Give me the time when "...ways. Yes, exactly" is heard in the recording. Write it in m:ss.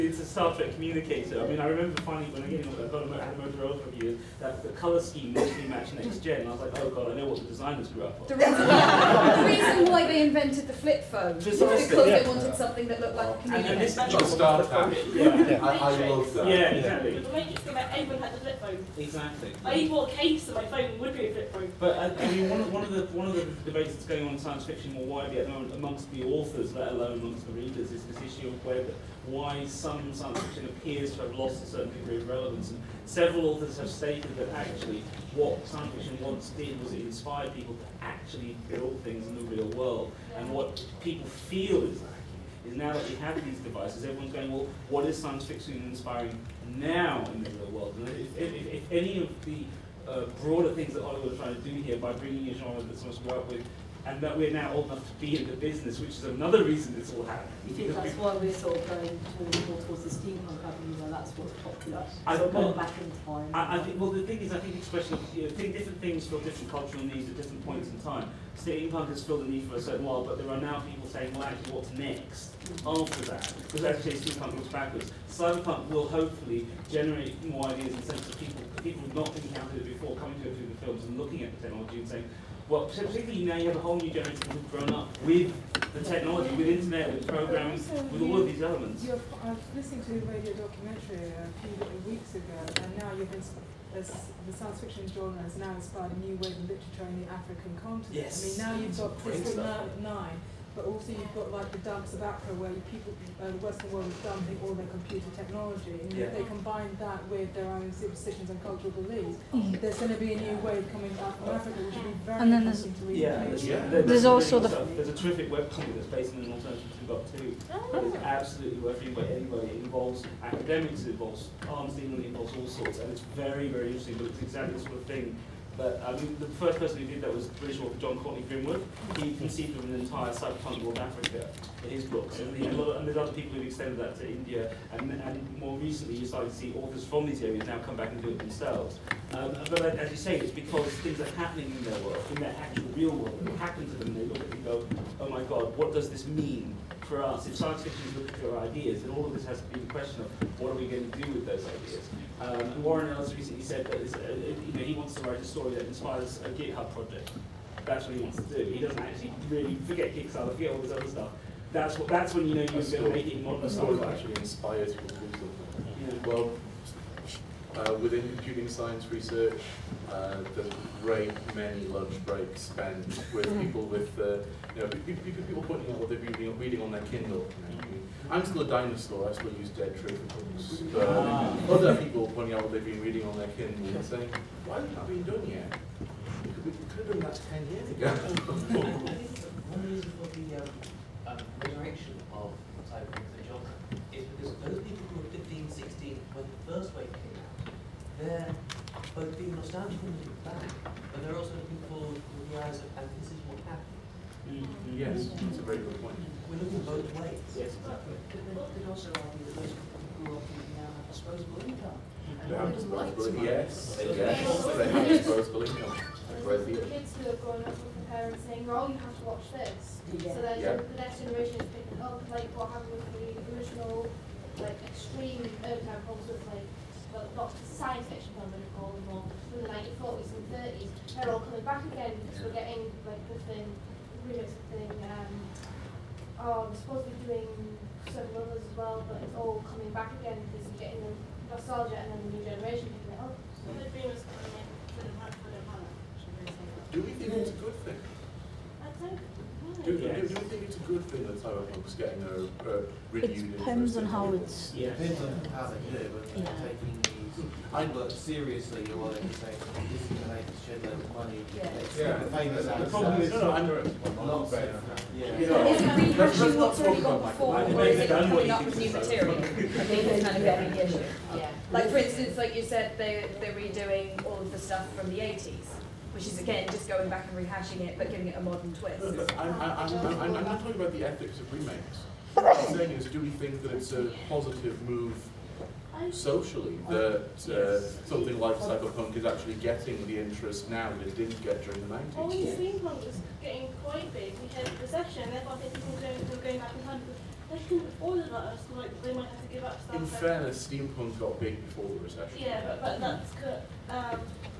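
3:27.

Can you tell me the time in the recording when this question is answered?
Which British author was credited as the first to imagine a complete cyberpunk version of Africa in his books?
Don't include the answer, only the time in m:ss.
2:07.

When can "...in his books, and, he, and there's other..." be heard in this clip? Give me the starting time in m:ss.
2:11.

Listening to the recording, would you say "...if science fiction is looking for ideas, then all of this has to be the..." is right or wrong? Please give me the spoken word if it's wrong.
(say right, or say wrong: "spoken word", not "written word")
right.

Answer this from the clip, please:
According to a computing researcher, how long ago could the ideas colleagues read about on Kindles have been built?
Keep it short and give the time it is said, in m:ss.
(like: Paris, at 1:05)
10 years, at 3:07.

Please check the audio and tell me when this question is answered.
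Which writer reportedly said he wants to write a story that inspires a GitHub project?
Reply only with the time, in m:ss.
2:32.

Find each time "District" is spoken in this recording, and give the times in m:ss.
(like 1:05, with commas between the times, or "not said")
1:39.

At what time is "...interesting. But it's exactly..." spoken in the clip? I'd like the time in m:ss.
2:03.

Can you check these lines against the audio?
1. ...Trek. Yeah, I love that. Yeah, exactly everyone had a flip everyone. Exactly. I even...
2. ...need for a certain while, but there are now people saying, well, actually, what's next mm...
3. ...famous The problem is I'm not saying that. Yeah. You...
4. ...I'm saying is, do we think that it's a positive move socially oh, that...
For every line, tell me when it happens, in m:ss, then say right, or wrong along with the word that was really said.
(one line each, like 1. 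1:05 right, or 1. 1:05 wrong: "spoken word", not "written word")
1. 0:14 wrong: "phone", not "everyone"
2. 1:09 right
3. 4:22 right
4. 4:42 right.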